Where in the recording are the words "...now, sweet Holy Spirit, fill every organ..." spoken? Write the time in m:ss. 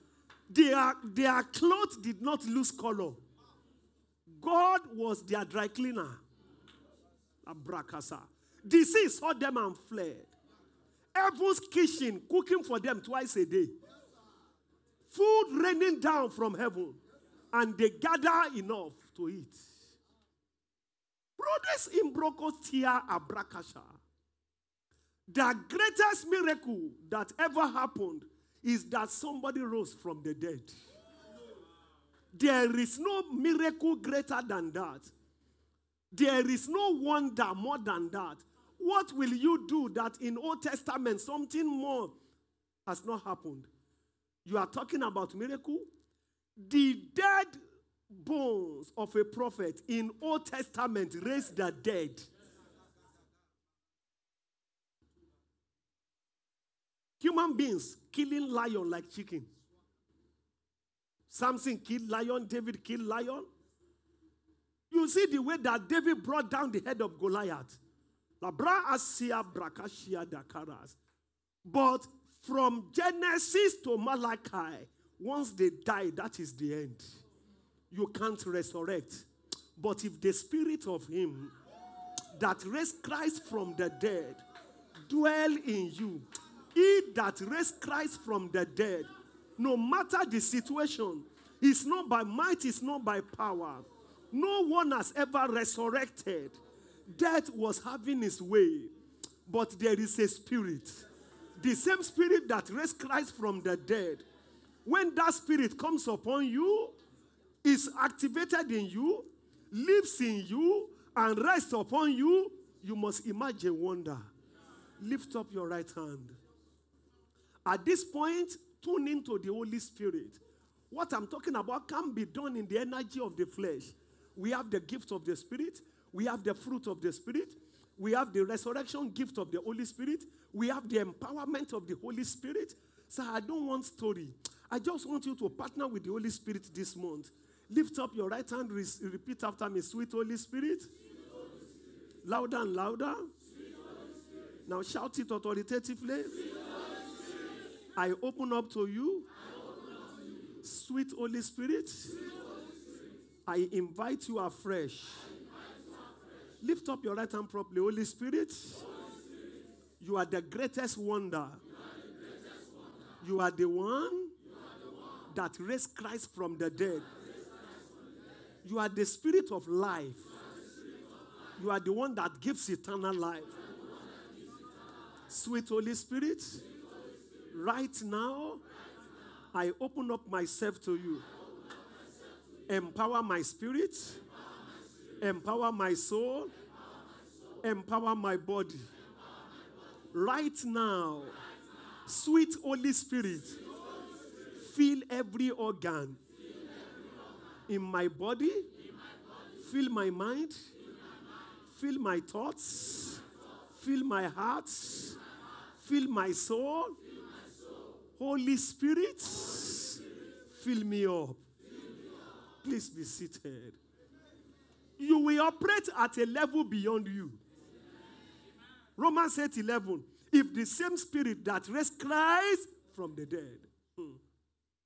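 3:10.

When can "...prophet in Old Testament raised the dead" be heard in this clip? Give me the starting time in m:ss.
0:49.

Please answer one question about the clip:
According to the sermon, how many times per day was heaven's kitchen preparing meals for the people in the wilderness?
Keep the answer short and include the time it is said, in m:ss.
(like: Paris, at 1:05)
twice a day, at 0:13.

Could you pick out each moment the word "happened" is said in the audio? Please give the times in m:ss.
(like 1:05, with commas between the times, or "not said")
0:27, 0:43.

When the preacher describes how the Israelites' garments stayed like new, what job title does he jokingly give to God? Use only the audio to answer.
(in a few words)
dry cleaner.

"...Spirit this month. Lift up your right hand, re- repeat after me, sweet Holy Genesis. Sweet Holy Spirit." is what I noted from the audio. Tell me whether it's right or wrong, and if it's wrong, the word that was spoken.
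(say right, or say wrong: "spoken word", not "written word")
wrong: "Spirit", not "Genesis".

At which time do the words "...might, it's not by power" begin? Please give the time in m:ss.
1:32.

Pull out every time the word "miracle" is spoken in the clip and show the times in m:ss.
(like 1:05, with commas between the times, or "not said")
0:26, 0:33, 0:45.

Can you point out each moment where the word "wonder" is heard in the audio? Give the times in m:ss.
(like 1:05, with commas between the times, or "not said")
0:36, 1:53, 2:40.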